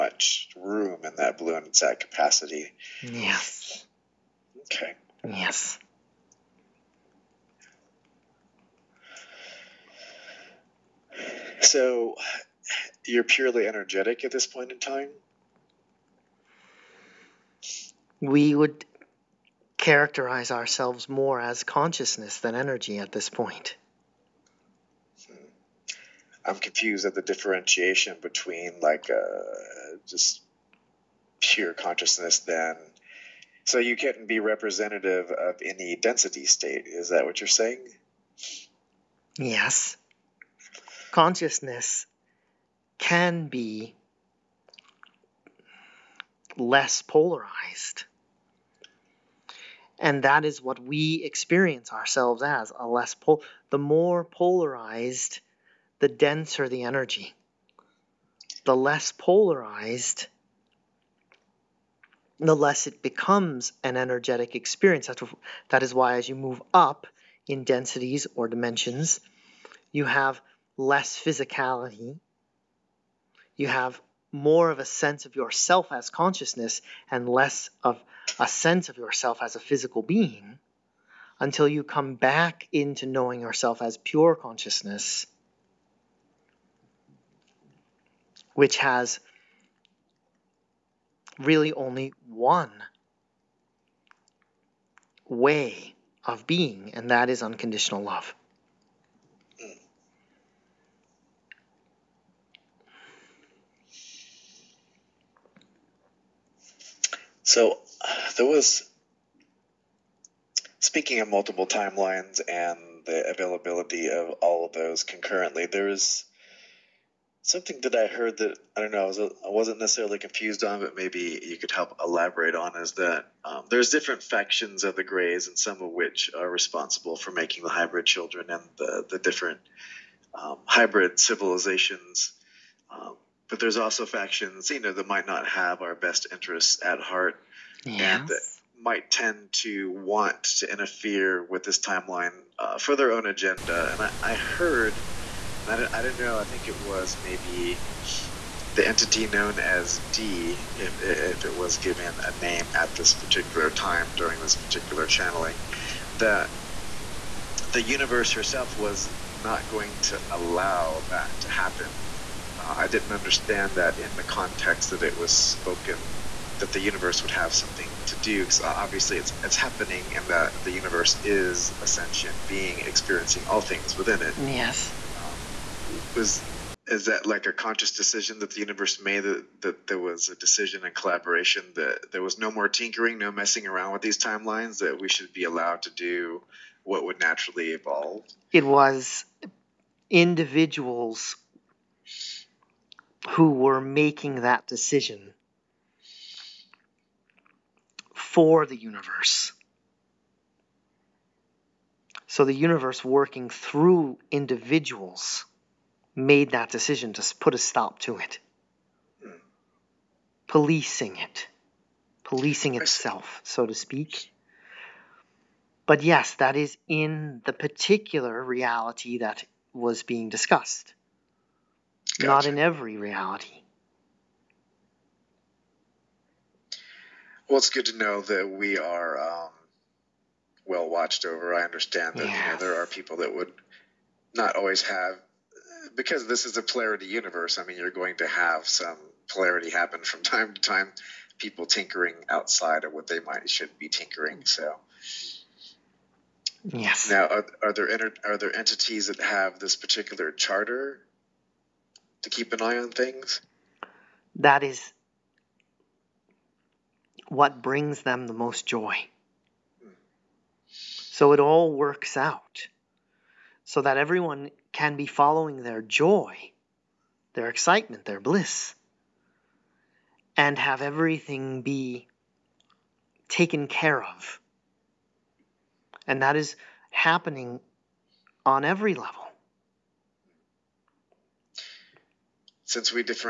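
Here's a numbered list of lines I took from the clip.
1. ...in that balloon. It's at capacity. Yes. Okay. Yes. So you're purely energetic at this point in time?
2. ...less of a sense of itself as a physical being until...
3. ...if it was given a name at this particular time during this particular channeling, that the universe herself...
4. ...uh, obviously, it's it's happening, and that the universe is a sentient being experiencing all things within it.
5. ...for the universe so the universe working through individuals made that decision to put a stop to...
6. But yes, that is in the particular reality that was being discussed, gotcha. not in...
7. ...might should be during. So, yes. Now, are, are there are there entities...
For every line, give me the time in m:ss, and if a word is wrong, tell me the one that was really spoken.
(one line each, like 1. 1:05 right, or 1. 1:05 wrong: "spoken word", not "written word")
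1. 0:01 right
2. 1:17 wrong: "yourself", not "itself"
3. 2:31 right
4. 2:48 right
5. 3:18 right
6. 3:35 right
7. 4:03 wrong: "tinkering", not "during".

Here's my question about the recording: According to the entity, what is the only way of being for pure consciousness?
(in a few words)
Unconditional love.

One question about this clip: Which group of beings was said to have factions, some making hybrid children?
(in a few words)
The Greys.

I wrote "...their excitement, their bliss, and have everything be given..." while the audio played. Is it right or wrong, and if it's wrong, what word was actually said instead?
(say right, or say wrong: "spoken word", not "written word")
wrong: "taken", not "given".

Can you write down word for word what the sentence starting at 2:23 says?
And I, I heard and I don't, I don't know.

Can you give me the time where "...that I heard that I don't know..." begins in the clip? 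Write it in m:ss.
1:57.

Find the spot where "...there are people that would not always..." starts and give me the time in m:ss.
3:52.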